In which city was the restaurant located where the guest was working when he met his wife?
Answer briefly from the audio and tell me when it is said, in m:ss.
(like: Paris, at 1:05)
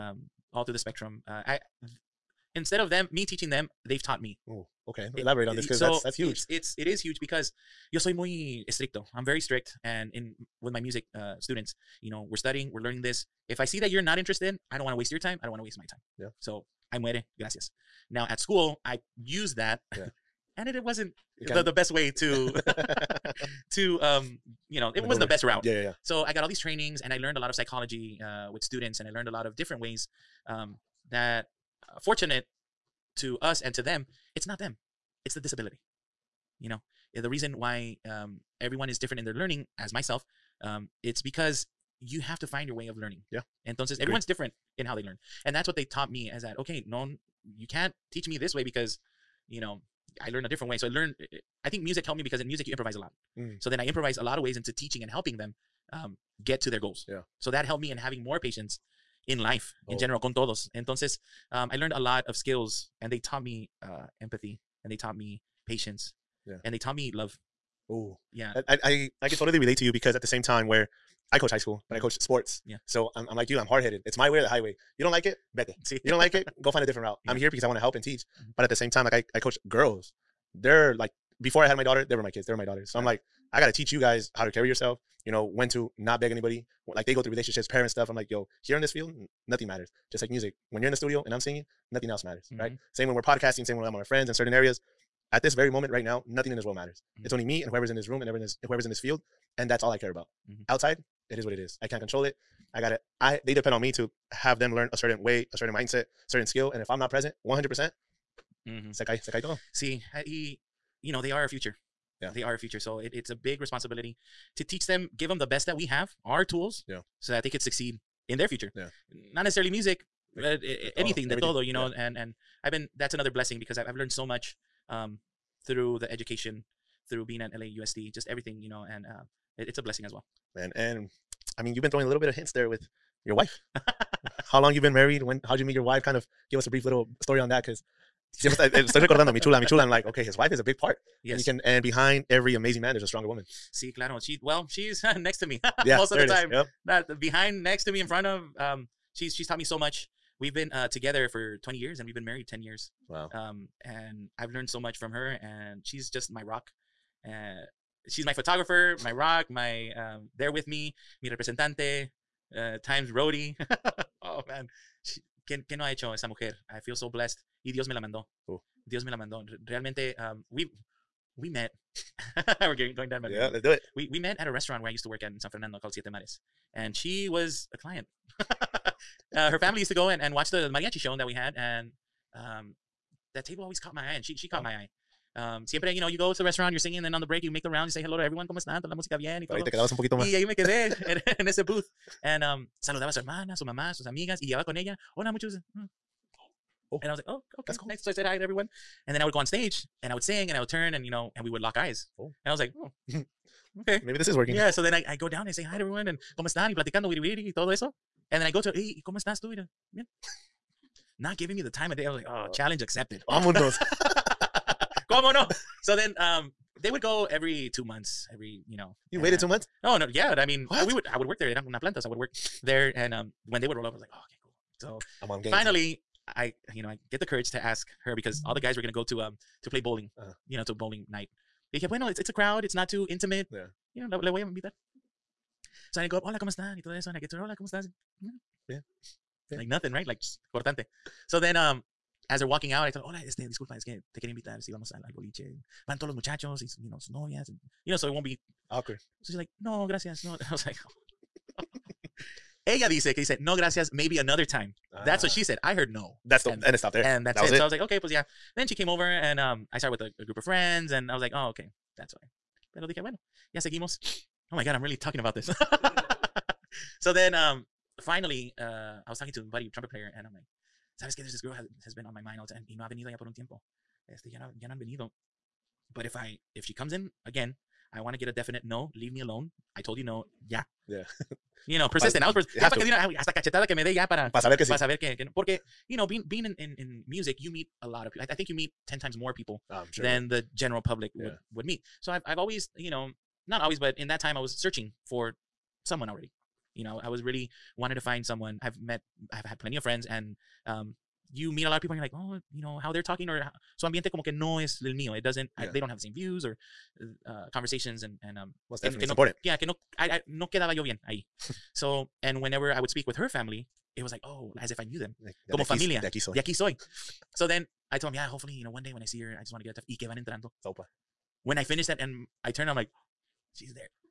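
San Fernando, at 2:55.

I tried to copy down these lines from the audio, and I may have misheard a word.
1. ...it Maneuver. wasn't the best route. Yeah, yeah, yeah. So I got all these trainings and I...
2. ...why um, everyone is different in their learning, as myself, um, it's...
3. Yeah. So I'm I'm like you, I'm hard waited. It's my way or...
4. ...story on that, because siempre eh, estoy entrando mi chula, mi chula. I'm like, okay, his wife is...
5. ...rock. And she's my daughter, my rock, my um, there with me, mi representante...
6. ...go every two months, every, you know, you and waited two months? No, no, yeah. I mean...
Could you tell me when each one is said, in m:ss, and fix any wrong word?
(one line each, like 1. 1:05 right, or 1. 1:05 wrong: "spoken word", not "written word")
1. 0:24 right
2. 0:37 right
3. 1:12 wrong: "headed", not "waited"
4. 2:17 wrong: "recordando", not "entrando"
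5. 2:36 wrong: "photographer", not "daughter"
6. 3:37 right.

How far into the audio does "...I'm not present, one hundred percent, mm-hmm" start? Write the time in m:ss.
1:46.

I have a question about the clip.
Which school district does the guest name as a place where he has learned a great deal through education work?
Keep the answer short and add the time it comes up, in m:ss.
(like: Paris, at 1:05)
LAUSD, at 2:07.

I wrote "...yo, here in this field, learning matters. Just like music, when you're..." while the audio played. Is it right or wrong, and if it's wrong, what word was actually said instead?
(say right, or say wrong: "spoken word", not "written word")
wrong: "nothing", not "learning".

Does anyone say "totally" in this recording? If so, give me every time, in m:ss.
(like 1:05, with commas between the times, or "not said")
1:09.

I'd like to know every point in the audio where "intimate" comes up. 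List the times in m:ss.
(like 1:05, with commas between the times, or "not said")
3:53.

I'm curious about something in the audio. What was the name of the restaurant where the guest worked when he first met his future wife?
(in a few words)
Siete Mares.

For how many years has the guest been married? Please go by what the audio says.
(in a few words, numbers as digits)
10.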